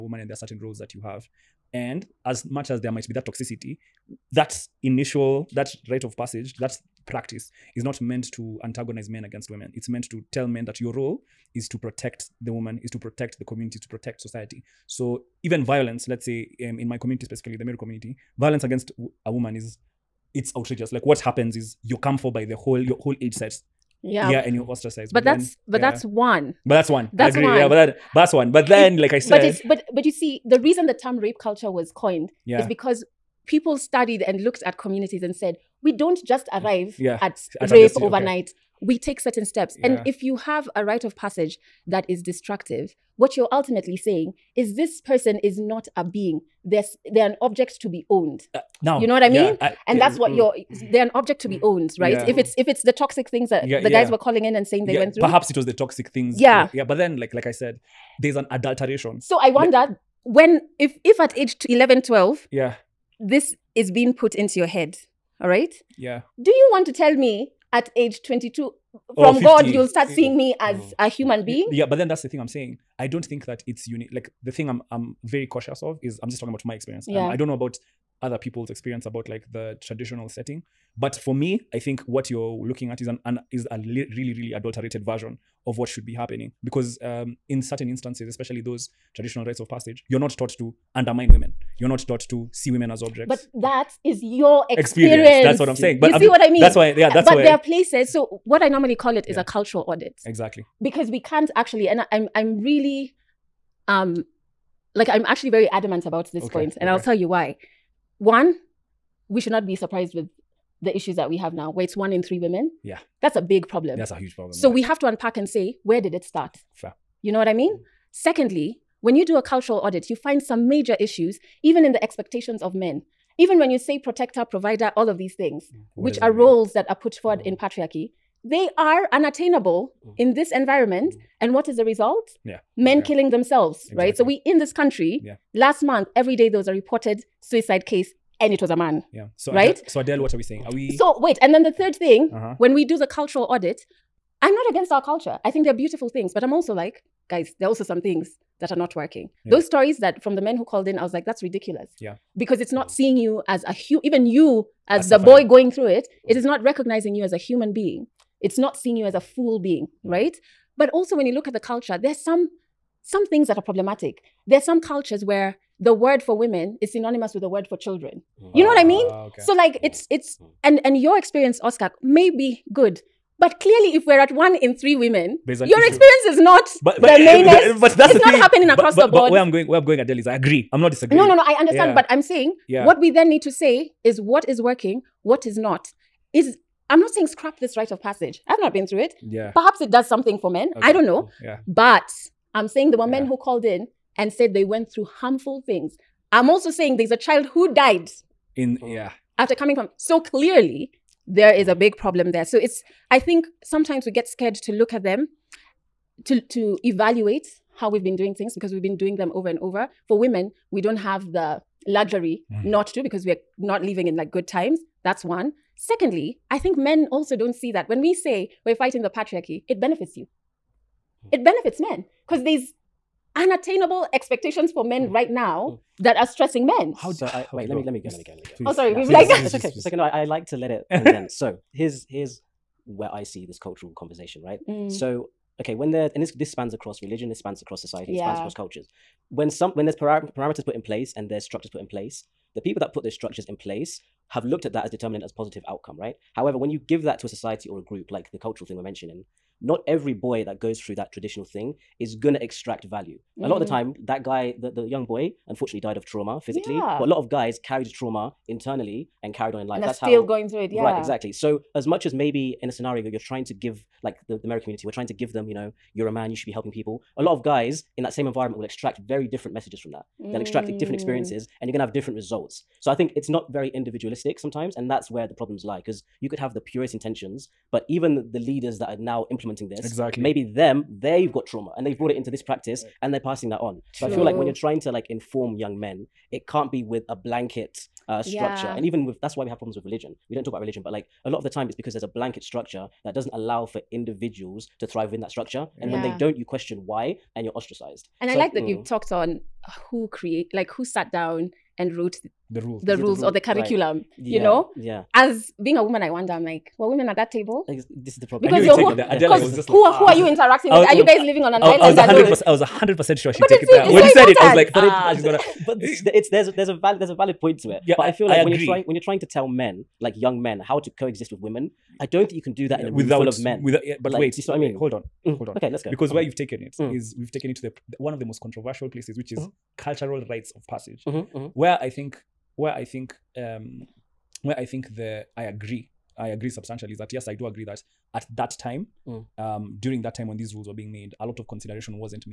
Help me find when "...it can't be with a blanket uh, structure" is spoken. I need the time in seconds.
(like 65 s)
286 s.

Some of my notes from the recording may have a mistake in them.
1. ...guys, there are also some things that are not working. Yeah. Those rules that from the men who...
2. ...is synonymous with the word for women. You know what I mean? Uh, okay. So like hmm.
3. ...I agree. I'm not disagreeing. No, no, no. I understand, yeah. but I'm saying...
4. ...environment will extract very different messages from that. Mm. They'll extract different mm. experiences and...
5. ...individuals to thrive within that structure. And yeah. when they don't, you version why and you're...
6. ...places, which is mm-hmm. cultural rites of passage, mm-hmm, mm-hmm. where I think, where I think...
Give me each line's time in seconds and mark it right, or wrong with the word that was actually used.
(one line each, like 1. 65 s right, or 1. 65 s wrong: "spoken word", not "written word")
1. 147 s wrong: "stories", not "rules"
2. 166 s wrong: "children", not "women"
3. 180 s right
4. 268 s right
5. 293 s wrong: "question", not "version"
6. 328 s right.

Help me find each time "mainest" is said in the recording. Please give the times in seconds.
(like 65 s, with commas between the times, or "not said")
177 s.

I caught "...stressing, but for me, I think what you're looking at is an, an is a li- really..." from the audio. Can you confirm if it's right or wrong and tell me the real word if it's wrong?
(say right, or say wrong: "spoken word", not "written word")
wrong: "setting", not "stressing".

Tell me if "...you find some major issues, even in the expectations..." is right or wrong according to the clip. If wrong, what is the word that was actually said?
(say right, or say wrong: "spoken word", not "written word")
right.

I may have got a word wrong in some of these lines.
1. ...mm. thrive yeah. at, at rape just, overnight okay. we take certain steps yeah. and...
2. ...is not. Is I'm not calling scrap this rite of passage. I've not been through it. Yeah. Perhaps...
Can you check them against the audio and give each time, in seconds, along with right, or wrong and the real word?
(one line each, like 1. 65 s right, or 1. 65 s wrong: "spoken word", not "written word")
1. 36 s wrong: "arrive", not "thrive"
2. 185 s wrong: "saying", not "calling".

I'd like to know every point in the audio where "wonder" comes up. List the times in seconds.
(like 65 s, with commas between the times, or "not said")
59 s, 306 s.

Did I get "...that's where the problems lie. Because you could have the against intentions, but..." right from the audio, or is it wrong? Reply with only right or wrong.
wrong.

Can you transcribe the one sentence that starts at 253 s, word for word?
time, that guy, the, the young boy, unfortunately died of trauma physically.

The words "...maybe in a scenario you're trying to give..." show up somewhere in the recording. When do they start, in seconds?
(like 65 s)
262 s.